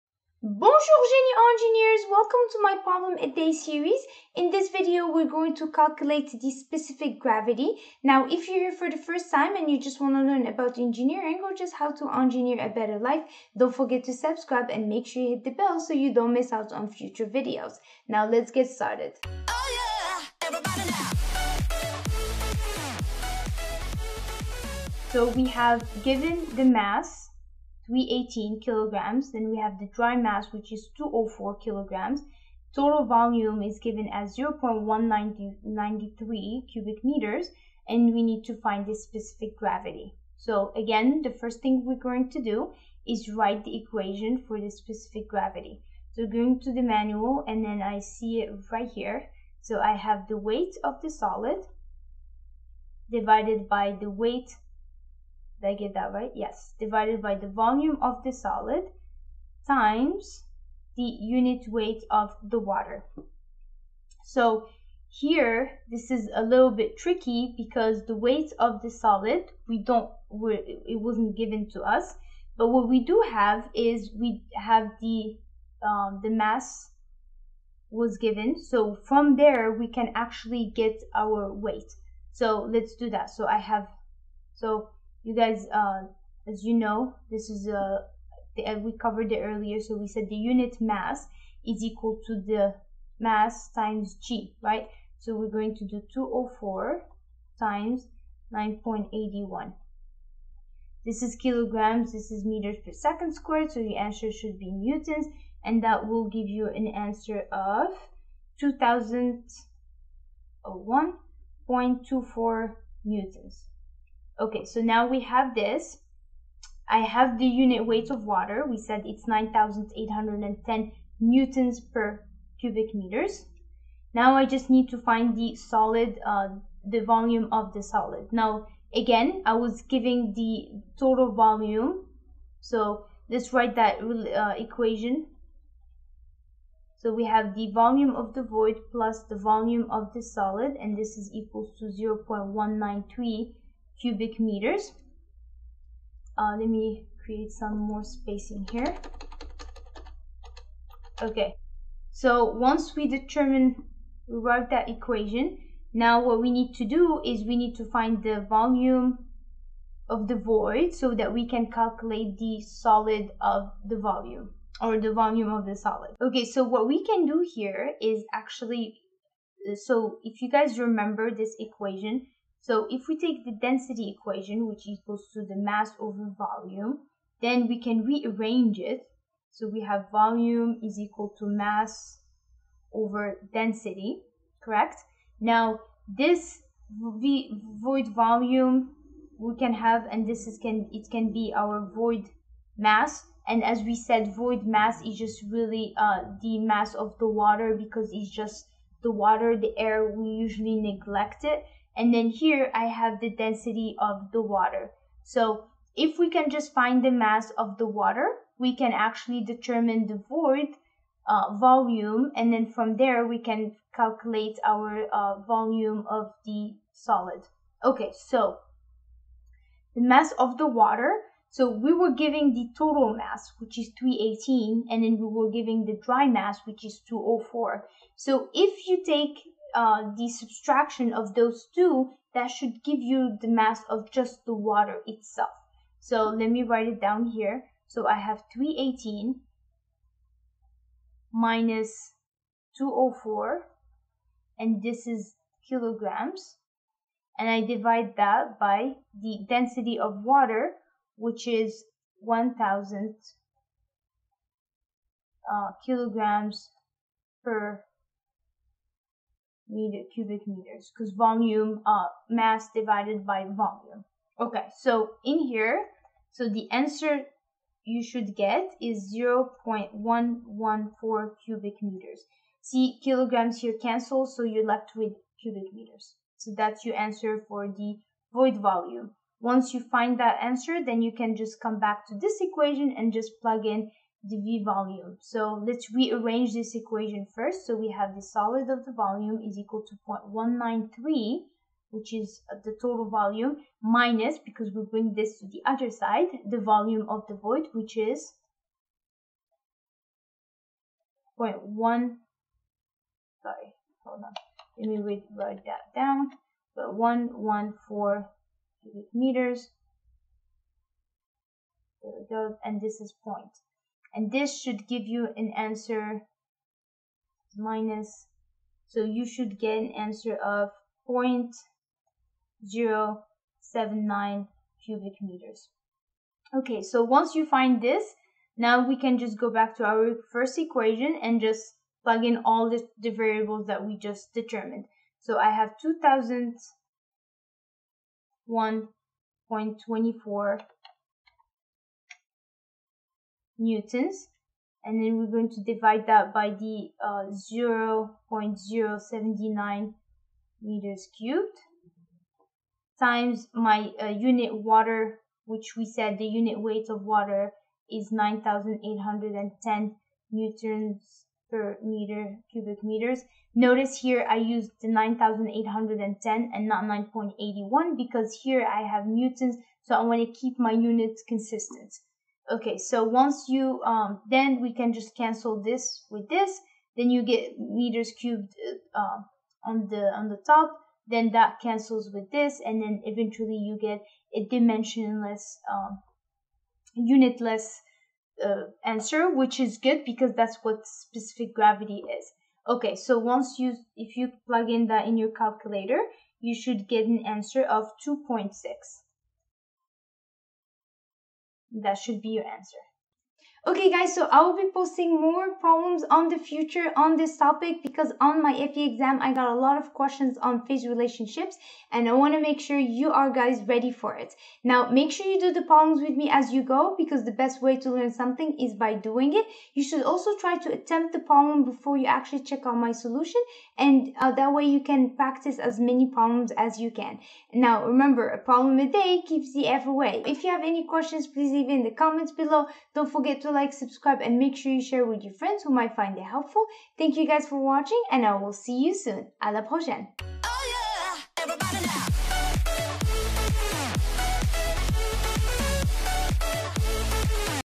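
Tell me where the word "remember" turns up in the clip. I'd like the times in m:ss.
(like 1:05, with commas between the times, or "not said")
2:50, 7:07.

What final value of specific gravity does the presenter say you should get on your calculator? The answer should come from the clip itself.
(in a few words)
2.6.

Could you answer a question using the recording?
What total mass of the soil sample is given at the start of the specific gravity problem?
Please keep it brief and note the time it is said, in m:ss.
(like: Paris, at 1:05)
318 kilograms, at 0:27.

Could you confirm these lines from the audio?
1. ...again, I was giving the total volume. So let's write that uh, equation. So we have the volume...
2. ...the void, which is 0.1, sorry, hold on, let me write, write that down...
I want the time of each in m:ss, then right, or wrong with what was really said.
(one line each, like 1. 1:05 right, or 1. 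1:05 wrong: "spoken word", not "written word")
1. 2:08 right
2. 4:57 right.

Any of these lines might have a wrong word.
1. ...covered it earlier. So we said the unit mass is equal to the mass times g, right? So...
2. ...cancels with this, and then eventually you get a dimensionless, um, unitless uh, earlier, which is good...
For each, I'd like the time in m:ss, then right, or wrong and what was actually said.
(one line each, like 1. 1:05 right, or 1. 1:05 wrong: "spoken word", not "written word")
1. 1:28 right
2. 6:21 wrong: "answer", not "earlier".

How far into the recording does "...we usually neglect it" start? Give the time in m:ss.
3:20.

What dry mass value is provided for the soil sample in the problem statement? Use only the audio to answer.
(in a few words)
204 kilograms.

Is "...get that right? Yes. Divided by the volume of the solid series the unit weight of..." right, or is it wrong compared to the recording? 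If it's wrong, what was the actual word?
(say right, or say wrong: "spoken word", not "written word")
wrong: "times", not "series".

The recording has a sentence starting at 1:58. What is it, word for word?
We said it's 9,810 newtons per cubic meters.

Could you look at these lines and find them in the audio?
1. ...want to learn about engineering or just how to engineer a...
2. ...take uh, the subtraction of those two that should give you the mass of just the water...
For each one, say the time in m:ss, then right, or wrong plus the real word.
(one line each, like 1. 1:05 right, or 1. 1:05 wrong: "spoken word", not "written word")
1. 0:10 right
2. 3:49 right.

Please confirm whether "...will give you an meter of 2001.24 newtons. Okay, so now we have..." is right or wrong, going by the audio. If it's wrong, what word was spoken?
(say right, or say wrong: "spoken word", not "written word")
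wrong: "answer", not "meter".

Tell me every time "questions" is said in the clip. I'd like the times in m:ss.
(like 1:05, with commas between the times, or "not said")
6:49, 7:10.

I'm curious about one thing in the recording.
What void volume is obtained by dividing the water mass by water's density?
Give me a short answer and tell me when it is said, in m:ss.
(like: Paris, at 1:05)
0.114 cubic meters, at 4:29.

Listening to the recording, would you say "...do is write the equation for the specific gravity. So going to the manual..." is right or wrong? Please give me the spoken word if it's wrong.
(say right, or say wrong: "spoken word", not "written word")
right.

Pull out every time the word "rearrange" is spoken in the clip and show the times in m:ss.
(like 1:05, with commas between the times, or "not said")
2:58, 4:45.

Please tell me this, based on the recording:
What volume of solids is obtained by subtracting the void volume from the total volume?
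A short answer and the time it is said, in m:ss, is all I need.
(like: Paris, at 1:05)
0.079 cubic meters, at 5:21.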